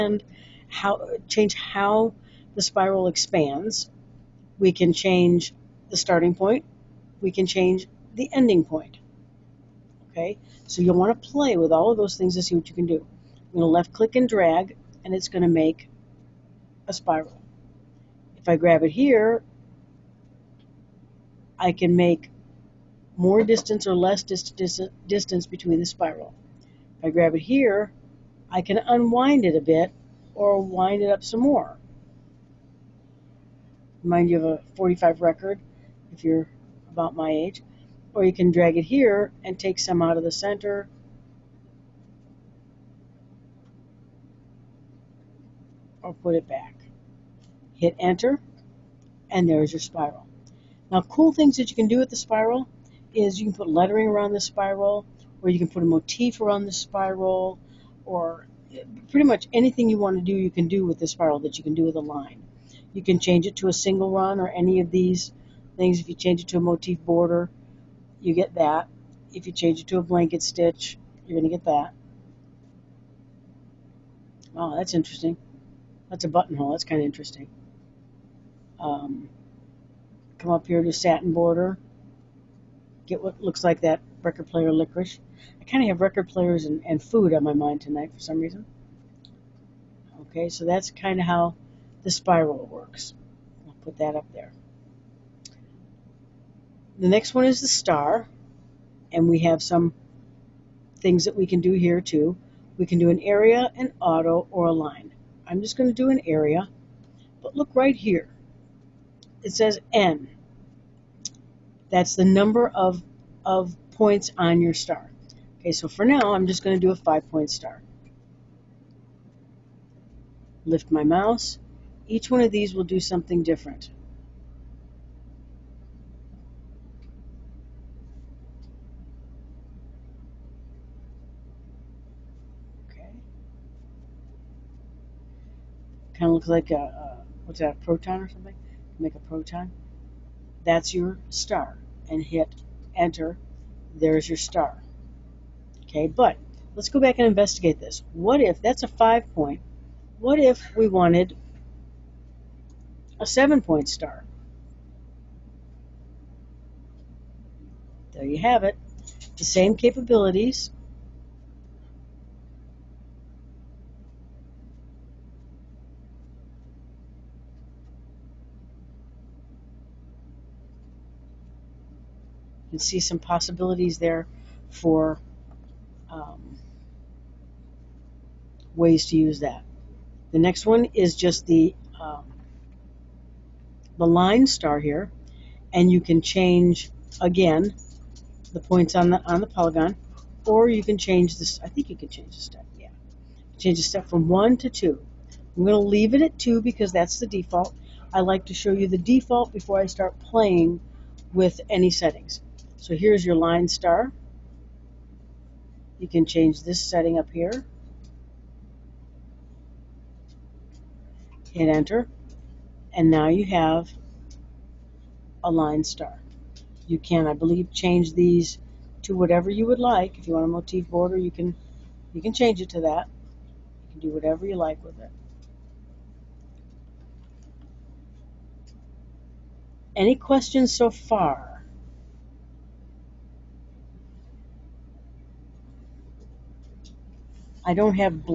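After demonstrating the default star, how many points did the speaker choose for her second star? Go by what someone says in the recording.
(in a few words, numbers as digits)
7.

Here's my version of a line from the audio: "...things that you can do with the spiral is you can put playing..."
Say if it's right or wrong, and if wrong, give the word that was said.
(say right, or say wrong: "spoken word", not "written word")
wrong: "lettering", not "playing".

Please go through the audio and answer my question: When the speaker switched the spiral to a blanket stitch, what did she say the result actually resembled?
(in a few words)
A buttonhole.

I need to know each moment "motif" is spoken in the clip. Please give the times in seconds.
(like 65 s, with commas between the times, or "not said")
55 s, 66 s, 220 s.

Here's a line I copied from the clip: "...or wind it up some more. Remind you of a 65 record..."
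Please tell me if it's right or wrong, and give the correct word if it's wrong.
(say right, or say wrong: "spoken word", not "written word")
wrong: "45", not "65".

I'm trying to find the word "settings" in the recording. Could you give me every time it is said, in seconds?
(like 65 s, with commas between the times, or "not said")
201 s, 206 s.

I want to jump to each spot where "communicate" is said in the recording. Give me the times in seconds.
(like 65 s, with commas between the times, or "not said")
not said.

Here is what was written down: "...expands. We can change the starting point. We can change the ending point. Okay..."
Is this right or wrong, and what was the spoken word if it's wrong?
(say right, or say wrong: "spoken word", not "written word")
right.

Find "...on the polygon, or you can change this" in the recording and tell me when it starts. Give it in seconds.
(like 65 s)
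189 s.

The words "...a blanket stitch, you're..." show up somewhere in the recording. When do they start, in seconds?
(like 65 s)
69 s.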